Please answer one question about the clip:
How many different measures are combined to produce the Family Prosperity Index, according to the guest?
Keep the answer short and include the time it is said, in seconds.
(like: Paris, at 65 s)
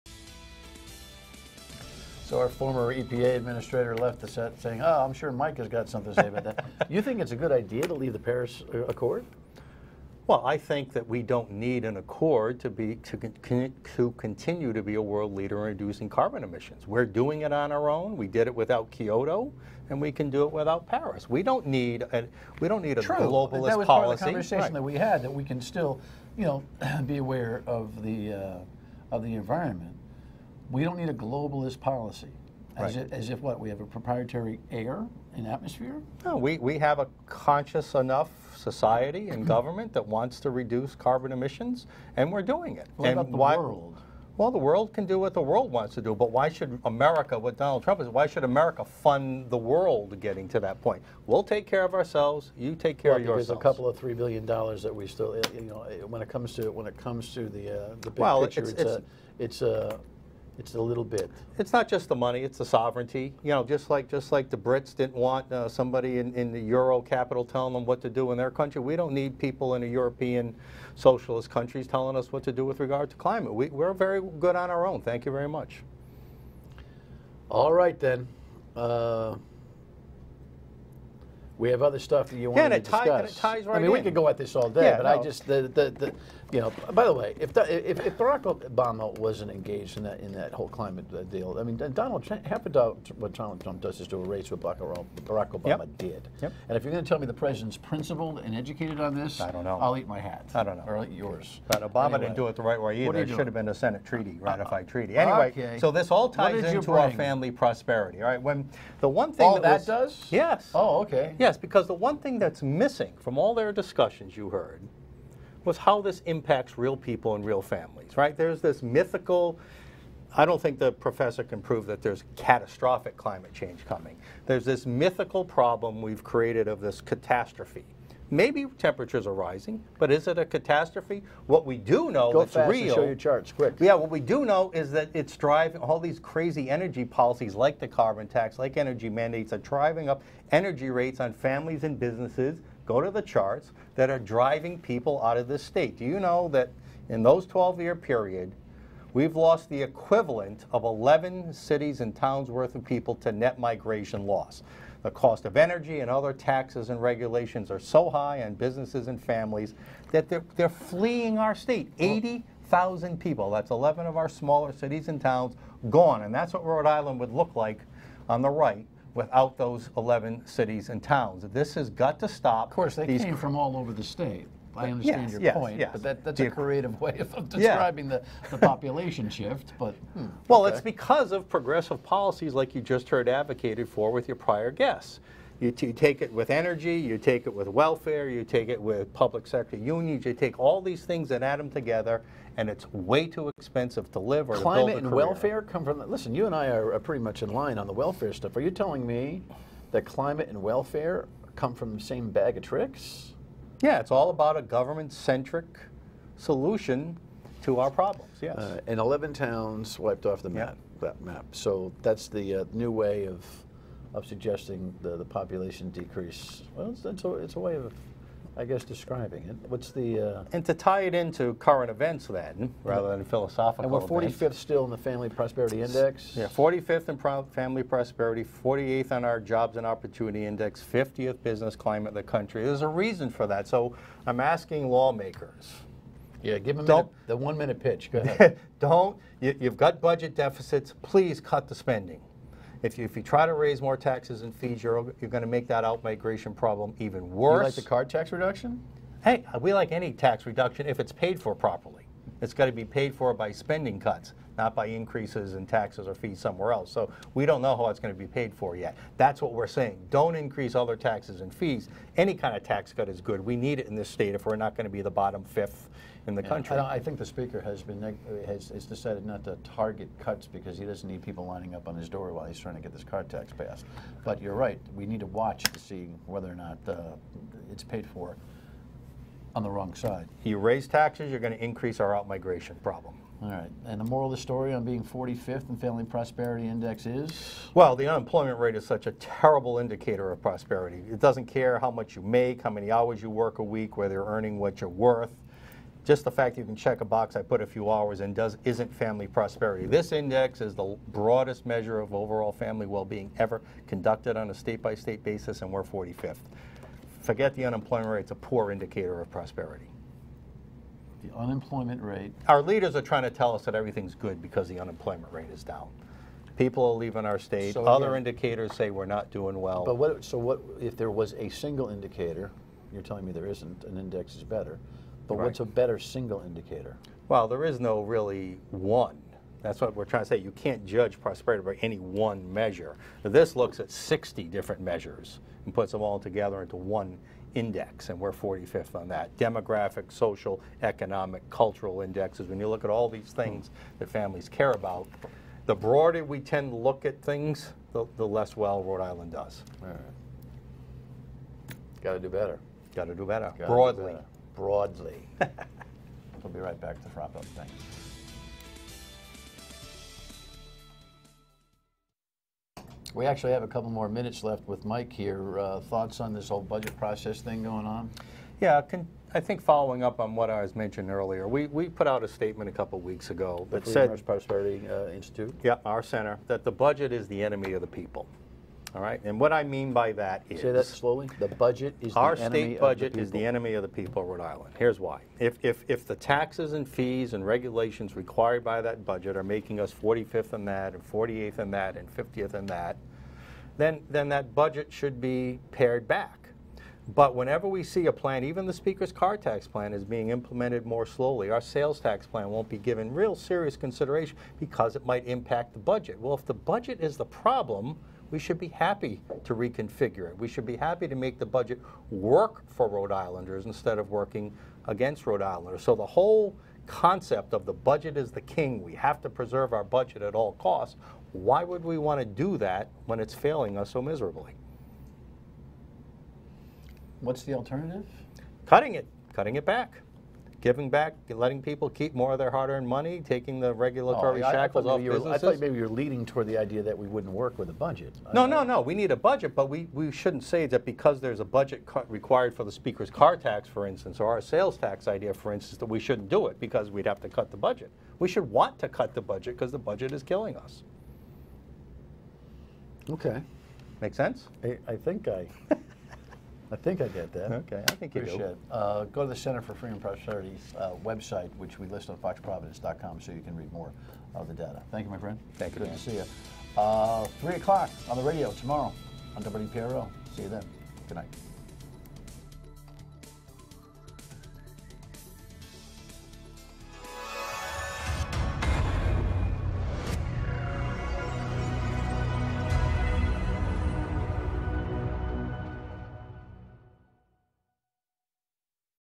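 60, at 333 s.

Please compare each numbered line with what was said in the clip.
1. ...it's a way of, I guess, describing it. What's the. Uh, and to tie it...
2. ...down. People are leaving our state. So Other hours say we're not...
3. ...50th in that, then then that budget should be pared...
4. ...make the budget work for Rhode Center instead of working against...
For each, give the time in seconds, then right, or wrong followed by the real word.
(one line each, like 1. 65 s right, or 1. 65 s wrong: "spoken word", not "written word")
1. 217 s right
2. 315 s wrong: "indicators", not "hours"
3. 392 s right
4. 411 s wrong: "Islanders", not "Center".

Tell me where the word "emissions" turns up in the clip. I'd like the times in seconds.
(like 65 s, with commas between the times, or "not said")
16 s, 41 s.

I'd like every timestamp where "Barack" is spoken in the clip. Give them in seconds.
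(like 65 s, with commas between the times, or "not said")
88 s, 94 s.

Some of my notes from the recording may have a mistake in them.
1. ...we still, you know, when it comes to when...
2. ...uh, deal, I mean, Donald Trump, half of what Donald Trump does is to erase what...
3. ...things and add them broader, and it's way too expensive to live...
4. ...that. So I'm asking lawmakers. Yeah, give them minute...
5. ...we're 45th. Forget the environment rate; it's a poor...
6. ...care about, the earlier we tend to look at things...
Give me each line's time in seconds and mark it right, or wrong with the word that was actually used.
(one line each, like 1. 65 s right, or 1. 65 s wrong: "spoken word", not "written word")
1. 54 s right
2. 91 s right
3. 191 s wrong: "together", not "broader"
4. 233 s right
5. 305 s wrong: "unemployment", not "environment"
6. 344 s wrong: "broader", not "earlier".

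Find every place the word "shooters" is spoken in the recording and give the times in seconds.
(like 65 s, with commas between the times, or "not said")
not said.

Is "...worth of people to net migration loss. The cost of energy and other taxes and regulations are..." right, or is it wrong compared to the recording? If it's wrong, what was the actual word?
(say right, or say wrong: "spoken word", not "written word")
right.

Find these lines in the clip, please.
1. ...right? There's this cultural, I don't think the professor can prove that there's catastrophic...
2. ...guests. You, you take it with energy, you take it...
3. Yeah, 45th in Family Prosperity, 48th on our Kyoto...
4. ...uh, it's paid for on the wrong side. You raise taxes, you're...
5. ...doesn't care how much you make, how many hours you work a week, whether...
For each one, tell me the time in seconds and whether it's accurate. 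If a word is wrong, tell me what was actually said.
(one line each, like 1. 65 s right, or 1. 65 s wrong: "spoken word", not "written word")
1. 118 s wrong: "mythical", not "cultural"
2. 184 s right
3. 226 s wrong: "Jobs", not "Kyoto"
4. 276 s right
5. 291 s right.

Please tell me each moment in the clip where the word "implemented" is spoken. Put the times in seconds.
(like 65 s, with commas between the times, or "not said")
400 s.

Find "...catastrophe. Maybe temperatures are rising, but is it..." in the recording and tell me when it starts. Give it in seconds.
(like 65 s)
127 s.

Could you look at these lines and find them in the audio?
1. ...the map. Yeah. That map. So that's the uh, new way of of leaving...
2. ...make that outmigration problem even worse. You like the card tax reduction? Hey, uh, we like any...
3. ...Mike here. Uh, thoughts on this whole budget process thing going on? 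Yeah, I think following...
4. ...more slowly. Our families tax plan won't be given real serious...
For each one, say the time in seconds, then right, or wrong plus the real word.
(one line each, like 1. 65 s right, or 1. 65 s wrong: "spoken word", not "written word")
1. 210 s wrong: "suggesting", not "leaving"
2. 245 s right
3. 364 s right
4. 400 s wrong: "sales", not "families".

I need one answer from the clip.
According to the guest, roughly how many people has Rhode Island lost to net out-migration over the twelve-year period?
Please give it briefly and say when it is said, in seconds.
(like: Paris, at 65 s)
80,000, at 161 s.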